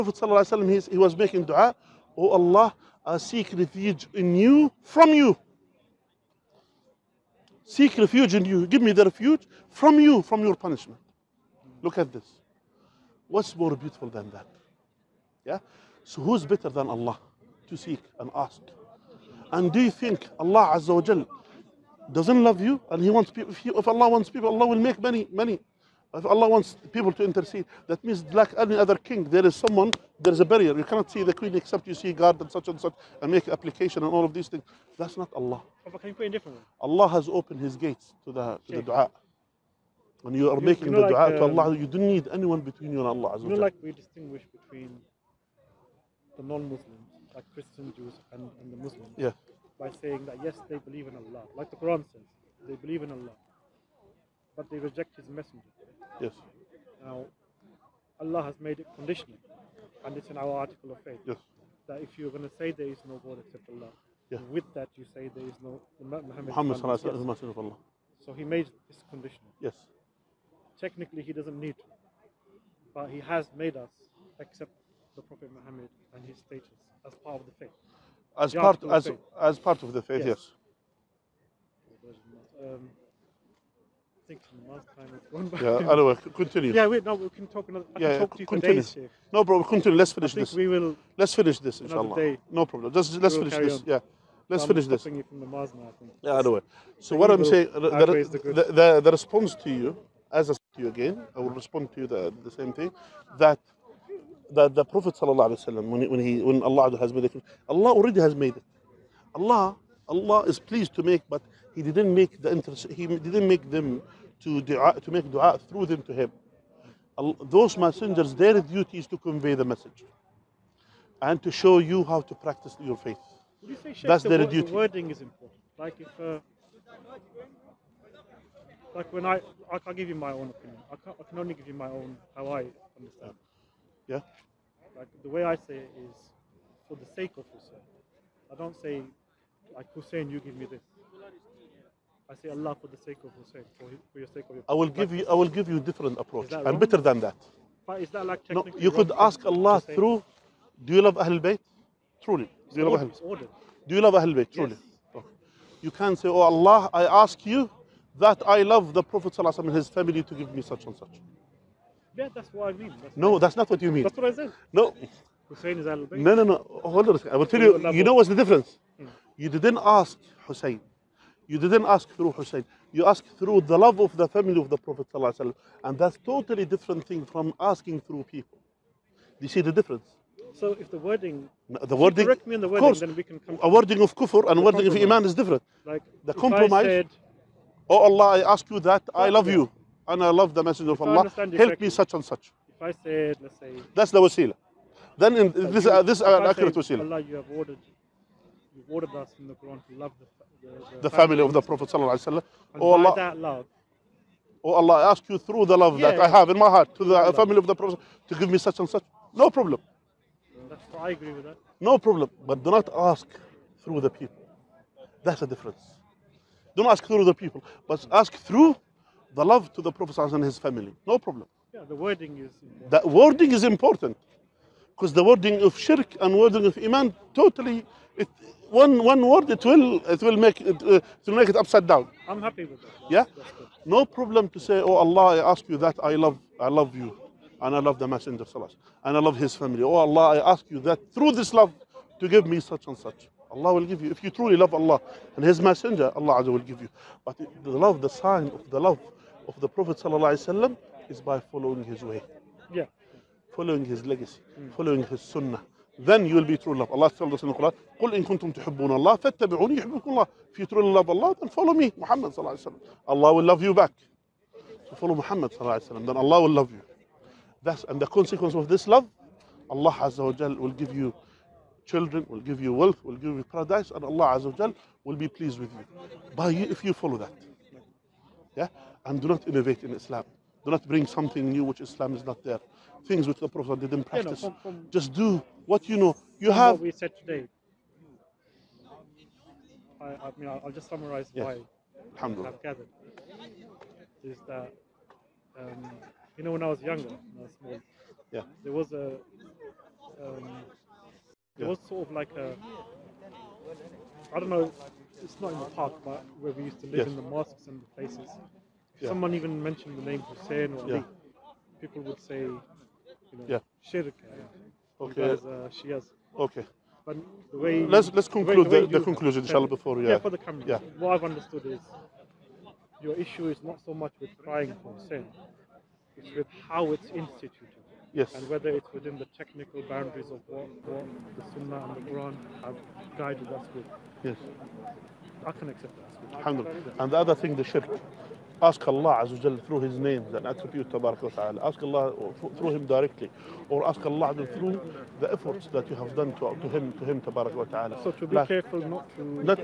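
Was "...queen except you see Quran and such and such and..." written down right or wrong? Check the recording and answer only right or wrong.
wrong.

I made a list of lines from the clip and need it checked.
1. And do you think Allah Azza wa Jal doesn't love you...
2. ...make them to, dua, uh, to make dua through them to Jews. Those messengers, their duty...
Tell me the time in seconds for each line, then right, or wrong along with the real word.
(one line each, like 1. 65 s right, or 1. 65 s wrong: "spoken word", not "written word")
1. 19 s right
2. 113 s wrong: "Him", not "Jews".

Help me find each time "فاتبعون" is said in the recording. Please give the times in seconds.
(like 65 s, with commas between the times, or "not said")
259 s.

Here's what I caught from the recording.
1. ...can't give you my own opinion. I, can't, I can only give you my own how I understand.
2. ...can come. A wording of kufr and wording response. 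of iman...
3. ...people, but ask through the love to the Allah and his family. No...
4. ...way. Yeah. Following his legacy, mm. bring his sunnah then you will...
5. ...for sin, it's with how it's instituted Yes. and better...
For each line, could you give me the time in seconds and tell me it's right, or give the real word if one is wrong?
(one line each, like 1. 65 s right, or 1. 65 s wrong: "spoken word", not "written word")
1. 129 s right
2. 183 s wrong: "compromise", not "response"
3. 217 s wrong: "Prophet", not "Allah"
4. 252 s wrong: "following", not "bring"
5. 324 s wrong: "whether", not "better".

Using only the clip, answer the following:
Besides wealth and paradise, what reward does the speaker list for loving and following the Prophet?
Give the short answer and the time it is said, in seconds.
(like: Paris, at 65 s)
children, at 271 s.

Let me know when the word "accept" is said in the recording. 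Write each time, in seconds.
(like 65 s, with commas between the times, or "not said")
74 s, 335 s.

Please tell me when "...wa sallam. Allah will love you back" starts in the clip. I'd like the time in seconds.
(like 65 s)
262 s.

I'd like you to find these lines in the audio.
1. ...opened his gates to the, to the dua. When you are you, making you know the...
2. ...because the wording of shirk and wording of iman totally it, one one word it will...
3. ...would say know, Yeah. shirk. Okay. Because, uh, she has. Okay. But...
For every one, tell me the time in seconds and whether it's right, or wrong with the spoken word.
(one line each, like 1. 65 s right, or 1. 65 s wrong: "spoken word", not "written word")
1. 37 s right
2. 224 s right
3. 312 s right.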